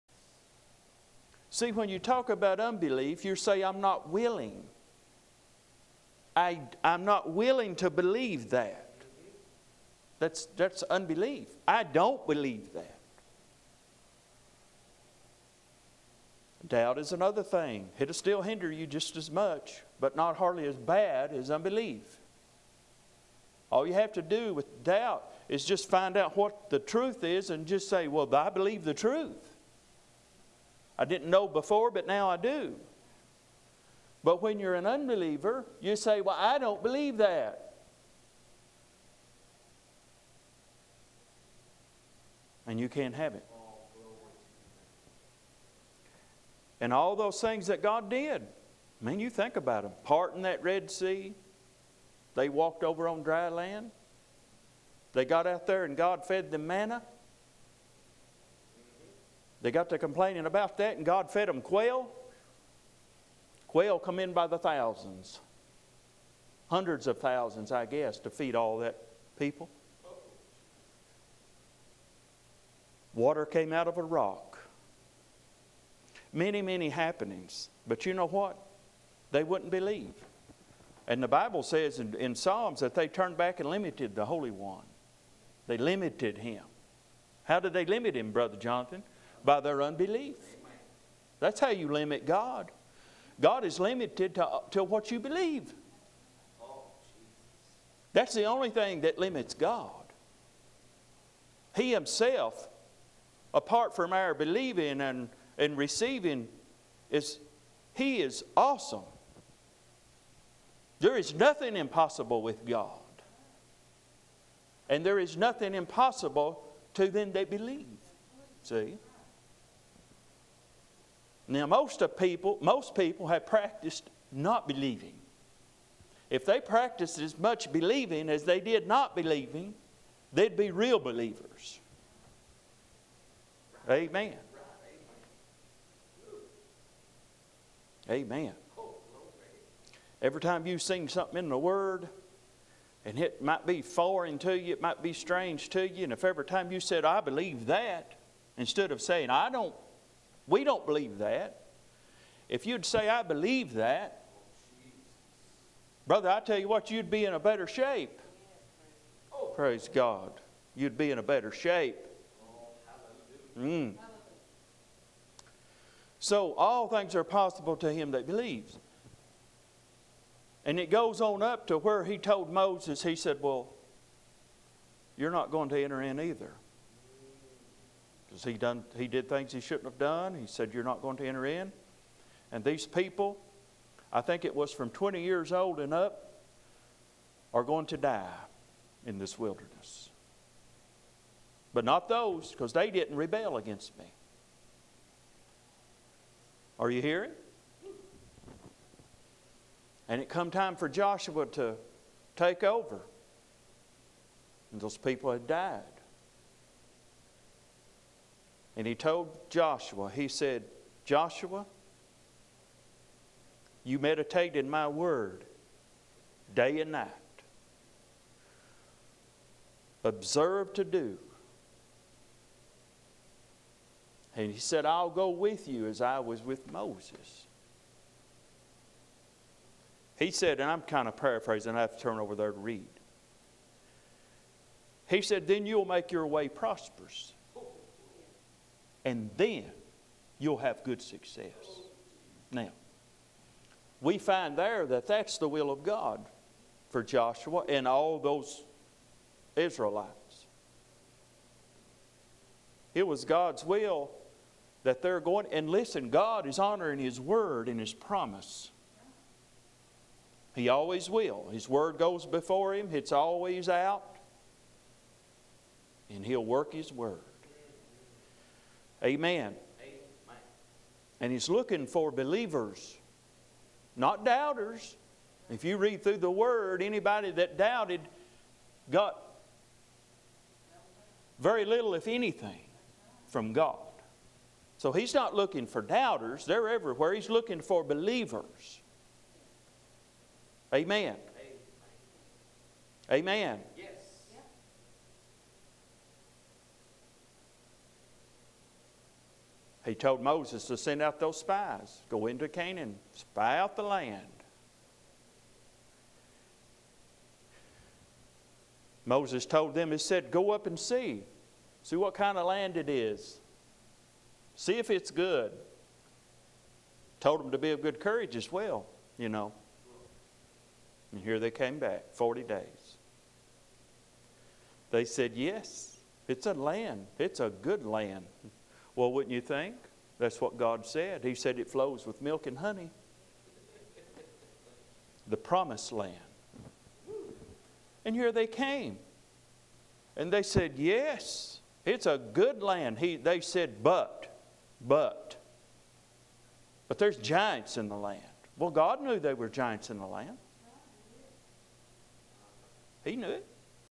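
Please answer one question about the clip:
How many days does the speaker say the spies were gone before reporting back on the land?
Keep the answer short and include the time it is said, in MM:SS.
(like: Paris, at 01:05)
40, at 05:22.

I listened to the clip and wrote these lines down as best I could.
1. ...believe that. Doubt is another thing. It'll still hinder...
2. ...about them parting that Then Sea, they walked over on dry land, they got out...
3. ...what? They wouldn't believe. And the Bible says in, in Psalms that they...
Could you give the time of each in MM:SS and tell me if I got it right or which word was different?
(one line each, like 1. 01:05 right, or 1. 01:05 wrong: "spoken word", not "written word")
1. 00:12 right
2. 00:49 wrong: "Red", not "Then"
3. 01:18 right.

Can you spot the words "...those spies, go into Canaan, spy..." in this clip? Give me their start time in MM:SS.
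05:01.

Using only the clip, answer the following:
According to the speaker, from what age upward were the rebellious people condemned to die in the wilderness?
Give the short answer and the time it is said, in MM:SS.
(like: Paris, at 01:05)
20 years old, at 03:04.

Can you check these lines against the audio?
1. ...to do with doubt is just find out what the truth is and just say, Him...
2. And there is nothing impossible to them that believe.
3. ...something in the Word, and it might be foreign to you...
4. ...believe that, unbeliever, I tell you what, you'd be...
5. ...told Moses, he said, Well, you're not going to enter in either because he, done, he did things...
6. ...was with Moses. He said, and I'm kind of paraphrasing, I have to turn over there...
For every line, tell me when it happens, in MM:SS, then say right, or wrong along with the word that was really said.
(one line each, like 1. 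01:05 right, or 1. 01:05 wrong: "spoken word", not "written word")
1. 00:24 wrong: "Well", not "Him"
2. 01:54 right
3. 02:21 right
4. 02:33 wrong: "brother", not "unbeliever"
5. 02:52 right
6. 03:46 right.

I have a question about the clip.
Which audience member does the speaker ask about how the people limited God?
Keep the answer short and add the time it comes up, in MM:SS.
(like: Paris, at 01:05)
Brother Jonathan, at 01:28.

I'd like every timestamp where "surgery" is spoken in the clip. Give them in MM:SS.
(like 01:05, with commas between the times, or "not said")
not said.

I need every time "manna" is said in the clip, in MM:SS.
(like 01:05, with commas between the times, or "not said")
00:56.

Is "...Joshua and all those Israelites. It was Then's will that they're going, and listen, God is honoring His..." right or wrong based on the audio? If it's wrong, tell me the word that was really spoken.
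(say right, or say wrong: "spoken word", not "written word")
wrong: "God", not "Then".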